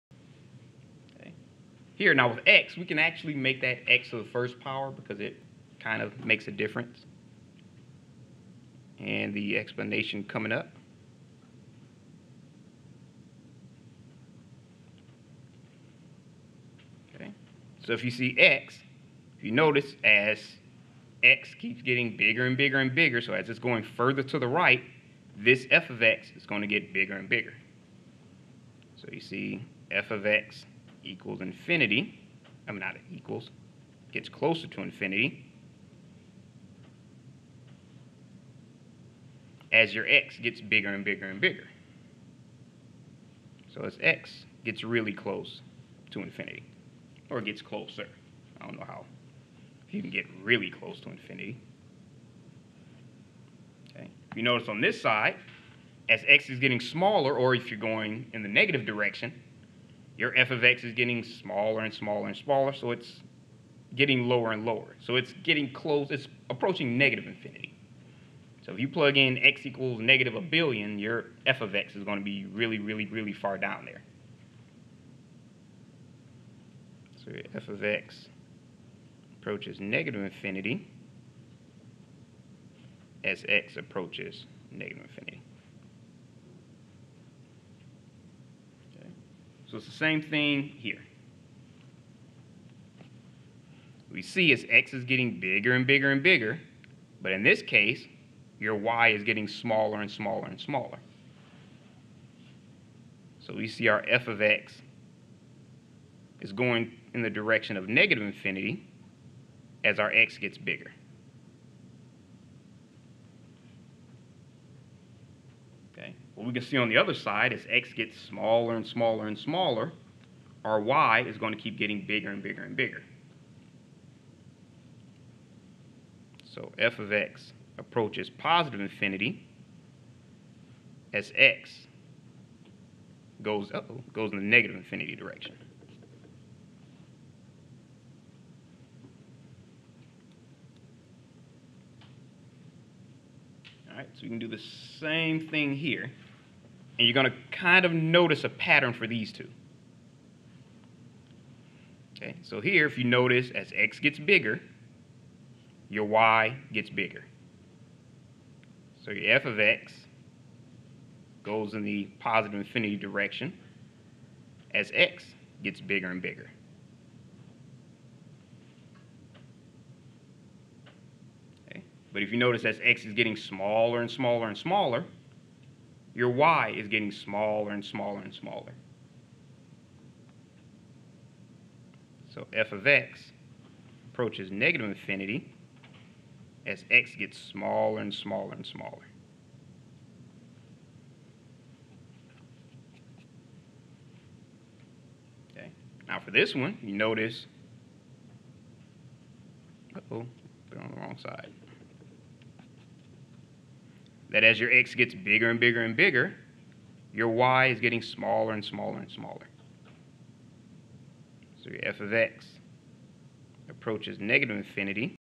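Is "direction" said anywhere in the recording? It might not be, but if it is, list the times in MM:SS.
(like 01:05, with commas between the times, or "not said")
00:58, 01:47, 02:15, 02:42.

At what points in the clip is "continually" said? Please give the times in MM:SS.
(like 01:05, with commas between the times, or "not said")
not said.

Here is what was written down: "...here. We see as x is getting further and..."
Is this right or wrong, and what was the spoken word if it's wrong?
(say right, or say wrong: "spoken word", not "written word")
wrong: "bigger", not "further".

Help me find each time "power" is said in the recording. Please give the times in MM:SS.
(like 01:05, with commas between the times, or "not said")
00:04.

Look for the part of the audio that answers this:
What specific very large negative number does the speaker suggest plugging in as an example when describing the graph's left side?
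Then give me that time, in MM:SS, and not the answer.
01:09.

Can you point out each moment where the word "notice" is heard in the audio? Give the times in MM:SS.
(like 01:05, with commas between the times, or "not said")
00:19, 00:54, 02:27, 02:33, 02:52, 03:16.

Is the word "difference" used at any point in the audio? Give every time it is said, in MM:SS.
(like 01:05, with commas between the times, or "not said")
00:06.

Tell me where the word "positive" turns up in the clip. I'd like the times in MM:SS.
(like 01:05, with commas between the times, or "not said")
02:08, 02:42.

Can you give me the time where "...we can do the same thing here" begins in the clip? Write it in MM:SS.
02:24.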